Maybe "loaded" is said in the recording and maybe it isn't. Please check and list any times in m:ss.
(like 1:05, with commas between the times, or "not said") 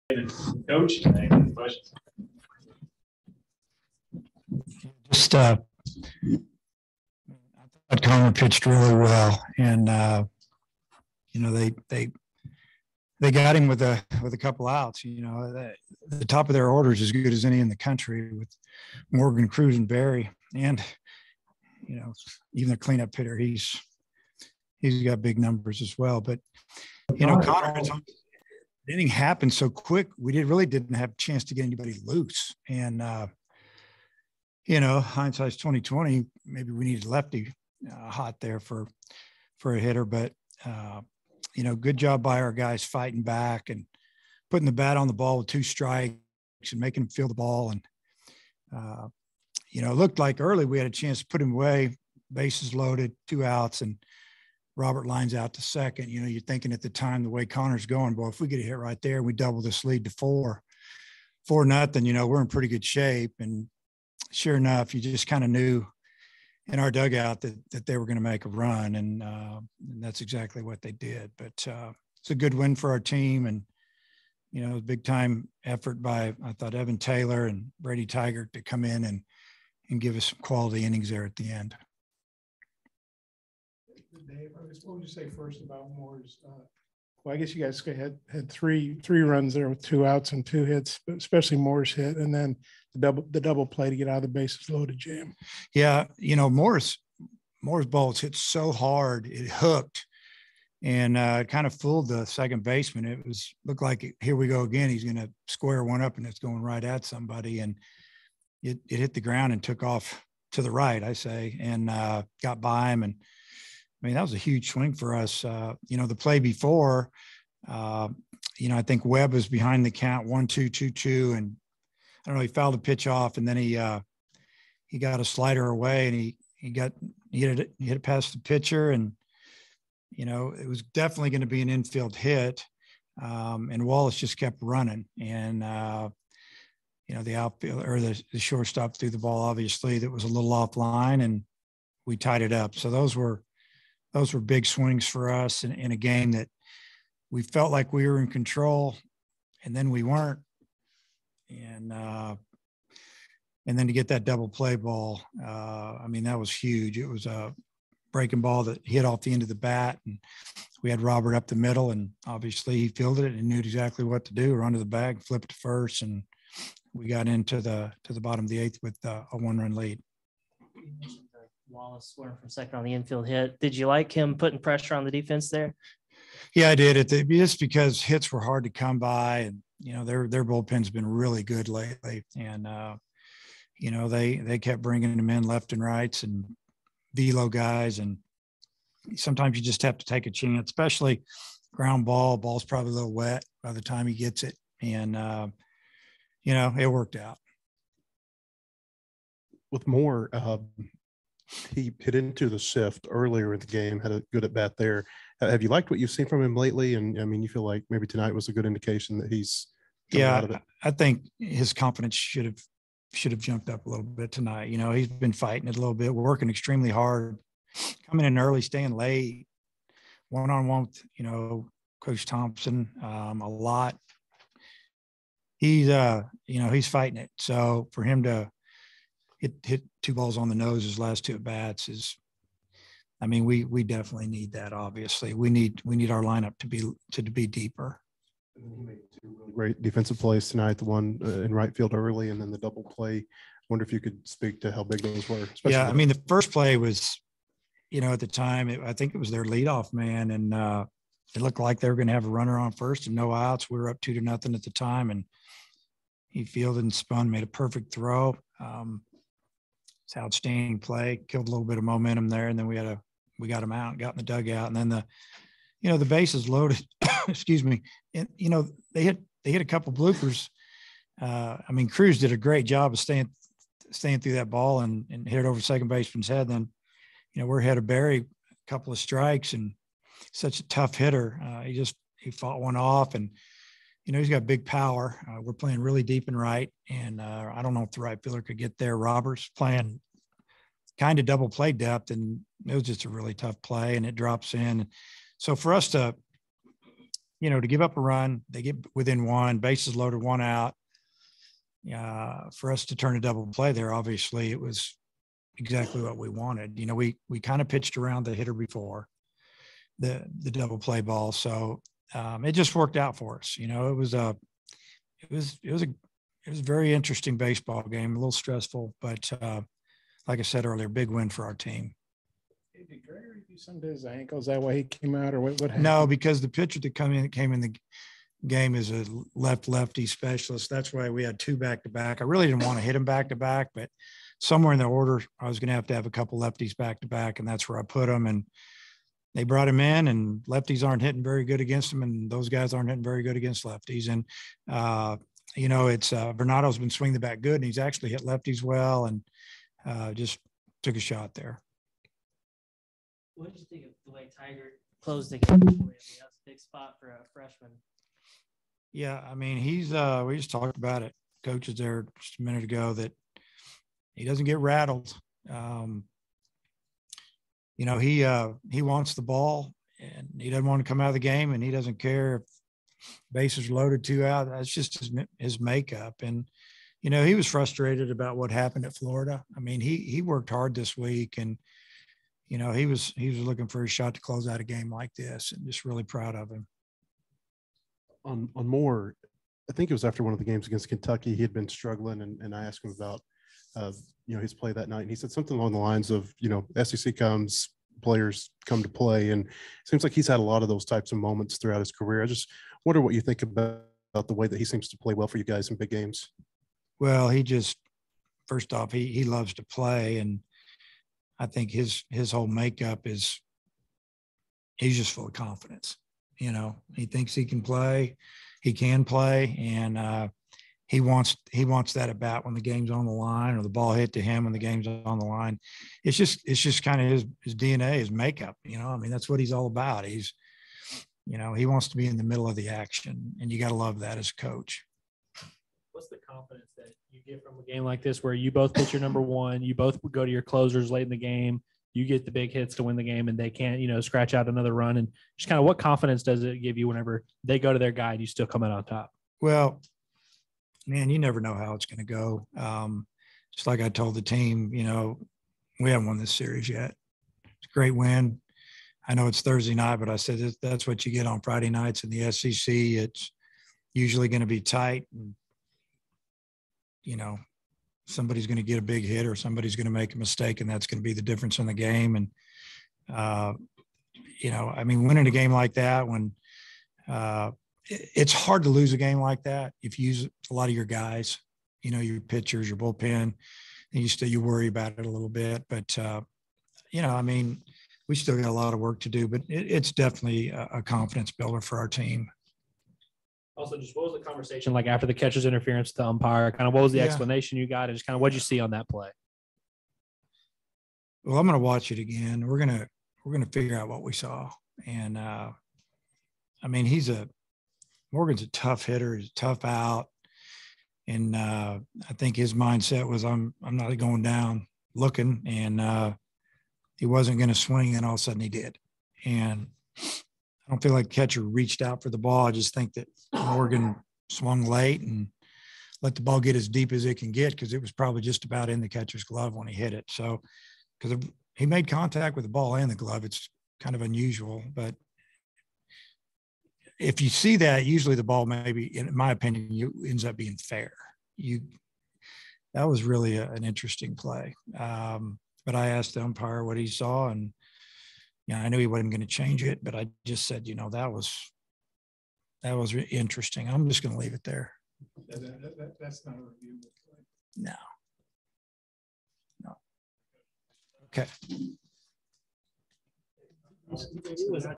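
0:52, 1:34, 4:26, 4:59, 6:13.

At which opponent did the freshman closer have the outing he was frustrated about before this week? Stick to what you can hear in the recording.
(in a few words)
Florida.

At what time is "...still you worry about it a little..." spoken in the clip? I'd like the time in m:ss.
8:04.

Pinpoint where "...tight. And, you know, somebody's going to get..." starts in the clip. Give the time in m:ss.
7:44.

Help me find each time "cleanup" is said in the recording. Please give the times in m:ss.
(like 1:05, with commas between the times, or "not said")
0:22.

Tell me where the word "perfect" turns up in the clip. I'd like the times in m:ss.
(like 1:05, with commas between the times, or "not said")
4:17.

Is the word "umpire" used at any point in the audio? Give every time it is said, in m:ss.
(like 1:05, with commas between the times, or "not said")
8:16, 9:06.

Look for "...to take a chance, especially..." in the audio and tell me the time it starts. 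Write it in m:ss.
3:09.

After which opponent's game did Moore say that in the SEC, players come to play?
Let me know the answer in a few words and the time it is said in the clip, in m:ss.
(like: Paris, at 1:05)
Kentucky, at 6:30.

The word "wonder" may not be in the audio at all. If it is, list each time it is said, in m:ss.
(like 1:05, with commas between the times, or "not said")
4:03, 6:42.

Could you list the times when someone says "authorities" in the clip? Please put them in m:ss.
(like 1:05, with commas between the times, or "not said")
not said.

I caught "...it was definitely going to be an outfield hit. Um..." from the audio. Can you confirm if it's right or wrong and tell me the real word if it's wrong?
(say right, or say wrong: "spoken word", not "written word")
wrong: "infield", not "outfield".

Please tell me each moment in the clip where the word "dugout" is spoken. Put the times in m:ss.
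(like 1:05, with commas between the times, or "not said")
1:06, 4:24.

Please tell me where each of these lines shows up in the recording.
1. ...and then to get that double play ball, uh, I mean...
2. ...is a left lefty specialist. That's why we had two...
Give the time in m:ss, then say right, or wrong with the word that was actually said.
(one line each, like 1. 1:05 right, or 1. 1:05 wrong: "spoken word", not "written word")
1. 2:33 right
2. 5:28 right.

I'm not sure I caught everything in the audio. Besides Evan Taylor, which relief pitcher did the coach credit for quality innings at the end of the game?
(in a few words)
Brady Tygart.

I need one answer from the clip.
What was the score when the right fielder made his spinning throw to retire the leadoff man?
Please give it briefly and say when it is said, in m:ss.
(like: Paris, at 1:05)
2-0, at 4:14.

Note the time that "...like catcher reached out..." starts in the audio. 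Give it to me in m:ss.
8:40.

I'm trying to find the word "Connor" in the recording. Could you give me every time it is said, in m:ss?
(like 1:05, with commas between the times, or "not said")
0:08, 0:27, 0:57.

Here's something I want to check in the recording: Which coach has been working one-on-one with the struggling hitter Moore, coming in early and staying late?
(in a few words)
Coach Thompson.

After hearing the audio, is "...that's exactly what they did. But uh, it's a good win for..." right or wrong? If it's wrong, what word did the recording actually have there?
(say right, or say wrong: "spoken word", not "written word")
right.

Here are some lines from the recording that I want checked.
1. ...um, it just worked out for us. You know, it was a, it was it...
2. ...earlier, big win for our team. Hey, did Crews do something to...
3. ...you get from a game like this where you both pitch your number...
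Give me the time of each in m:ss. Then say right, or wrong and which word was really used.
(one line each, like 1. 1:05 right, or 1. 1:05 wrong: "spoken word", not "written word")
1. 5:12 right
2. 5:20 wrong: "Gregory", not "Crews"
3. 7:17 right.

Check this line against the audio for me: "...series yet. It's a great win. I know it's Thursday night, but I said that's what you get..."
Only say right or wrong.
right.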